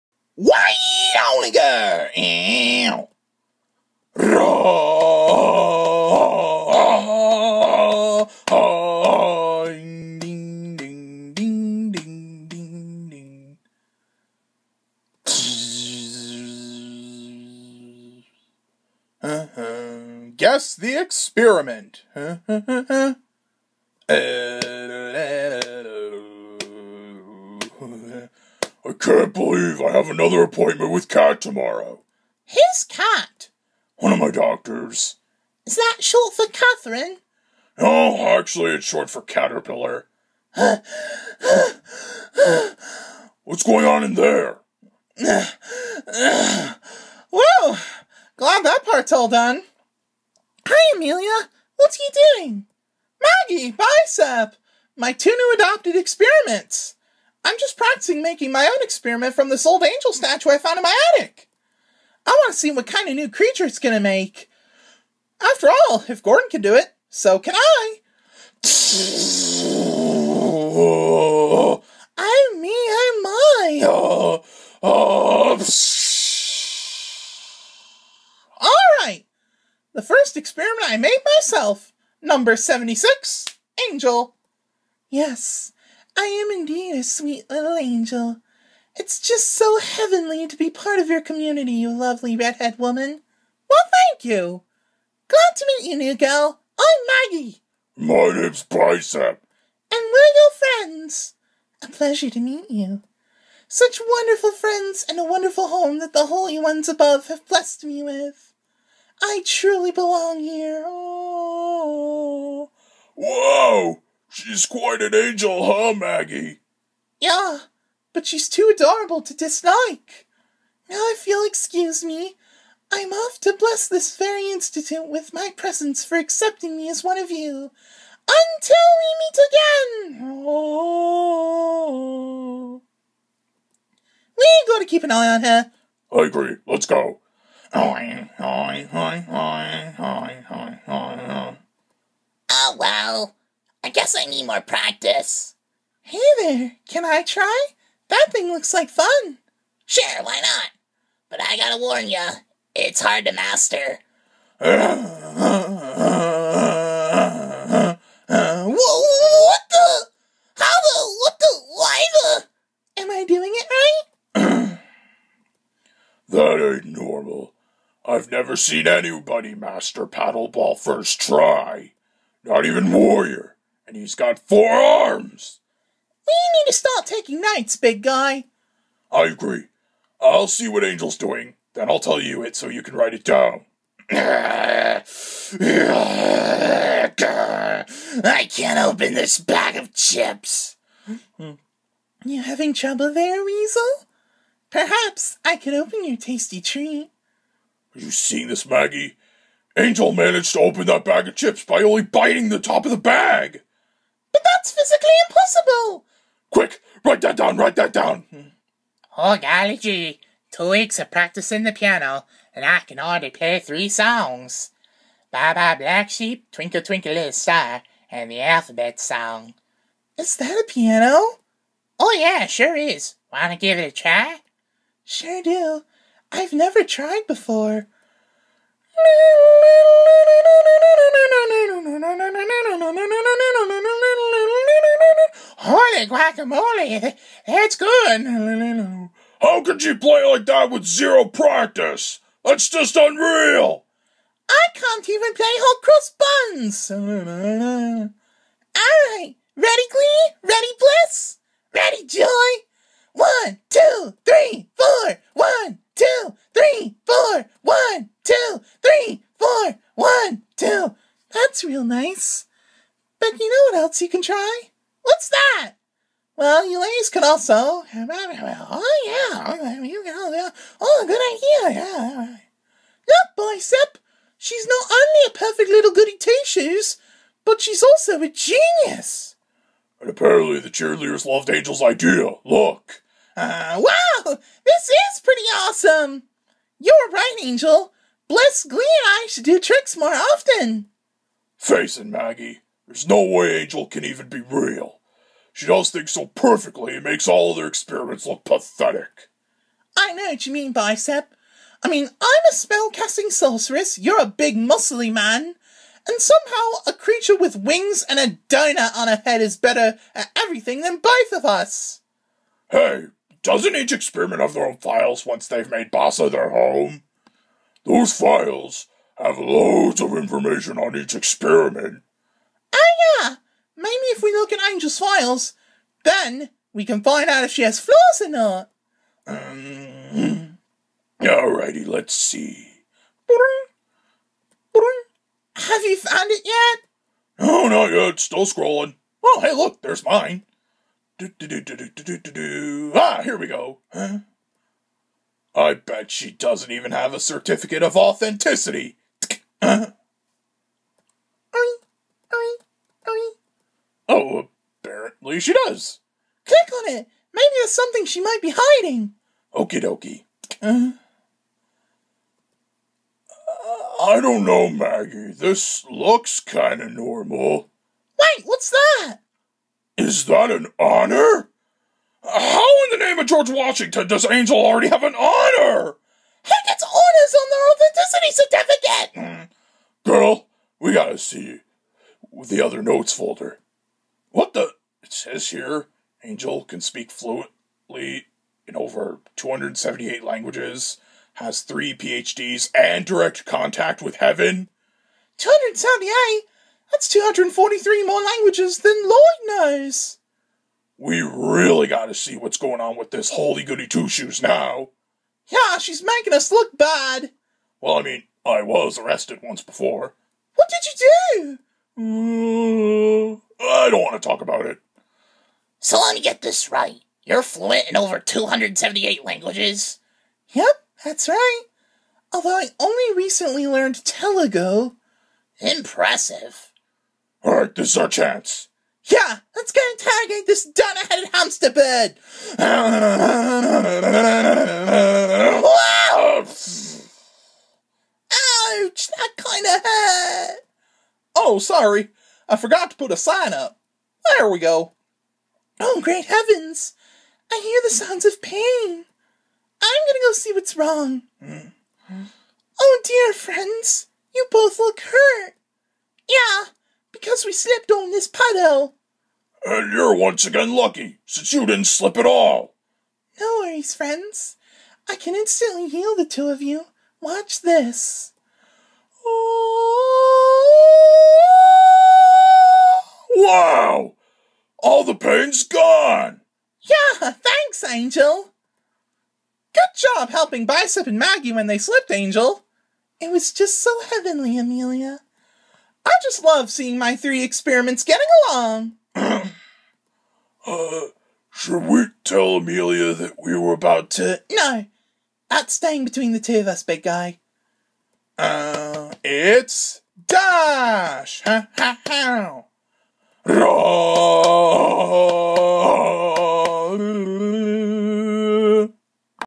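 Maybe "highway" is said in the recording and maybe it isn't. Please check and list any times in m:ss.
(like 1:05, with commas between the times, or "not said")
not said.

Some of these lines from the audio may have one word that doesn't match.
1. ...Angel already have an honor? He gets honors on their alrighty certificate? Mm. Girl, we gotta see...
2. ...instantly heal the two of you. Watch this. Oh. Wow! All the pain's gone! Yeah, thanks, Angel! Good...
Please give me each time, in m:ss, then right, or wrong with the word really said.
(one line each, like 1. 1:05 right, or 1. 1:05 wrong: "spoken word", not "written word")
1. 6:14 wrong: "authenticity", not "alrighty"
2. 7:45 right.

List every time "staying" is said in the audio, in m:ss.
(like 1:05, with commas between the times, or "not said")
8:15.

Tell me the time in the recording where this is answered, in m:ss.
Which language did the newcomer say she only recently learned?
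7:04.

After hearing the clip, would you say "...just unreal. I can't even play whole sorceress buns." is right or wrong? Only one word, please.
wrong.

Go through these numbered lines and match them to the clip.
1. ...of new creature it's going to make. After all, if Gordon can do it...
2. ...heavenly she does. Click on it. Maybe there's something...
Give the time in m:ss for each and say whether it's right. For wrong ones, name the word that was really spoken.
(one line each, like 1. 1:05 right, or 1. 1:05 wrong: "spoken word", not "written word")
1. 1:03 right
2. 5:54 wrong: "apparently", not "heavenly".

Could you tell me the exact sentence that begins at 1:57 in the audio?
Yeah, but she's too adorable to dislike.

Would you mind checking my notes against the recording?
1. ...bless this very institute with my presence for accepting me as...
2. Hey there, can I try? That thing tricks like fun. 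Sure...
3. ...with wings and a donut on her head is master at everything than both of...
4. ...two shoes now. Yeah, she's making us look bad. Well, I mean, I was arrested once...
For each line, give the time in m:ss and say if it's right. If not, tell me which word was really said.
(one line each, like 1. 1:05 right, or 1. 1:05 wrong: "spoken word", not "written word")
1. 2:03 right
2. 2:26 wrong: "looks", not "tricks"
3. 5:07 wrong: "better", not "master"
4. 6:43 right.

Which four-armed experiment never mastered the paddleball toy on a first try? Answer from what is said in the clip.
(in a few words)
Warrior.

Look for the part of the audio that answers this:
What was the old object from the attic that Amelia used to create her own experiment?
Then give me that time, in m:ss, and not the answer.
0:59.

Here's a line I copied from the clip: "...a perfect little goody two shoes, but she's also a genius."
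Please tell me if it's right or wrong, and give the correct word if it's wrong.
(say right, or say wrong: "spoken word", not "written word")
right.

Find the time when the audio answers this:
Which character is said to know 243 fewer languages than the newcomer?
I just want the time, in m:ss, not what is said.
6:39.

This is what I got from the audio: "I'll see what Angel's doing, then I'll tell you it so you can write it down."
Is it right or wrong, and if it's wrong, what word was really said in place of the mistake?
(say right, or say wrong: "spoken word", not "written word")
right.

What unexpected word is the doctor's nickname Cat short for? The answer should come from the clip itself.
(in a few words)
Caterpillar.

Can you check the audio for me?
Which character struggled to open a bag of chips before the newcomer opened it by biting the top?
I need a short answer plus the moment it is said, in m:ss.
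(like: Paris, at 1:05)
Weasel, at 3:13.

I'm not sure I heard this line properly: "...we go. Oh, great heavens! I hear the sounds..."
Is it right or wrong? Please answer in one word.
right.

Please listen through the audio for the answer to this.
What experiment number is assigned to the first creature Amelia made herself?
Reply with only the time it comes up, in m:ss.
1:22.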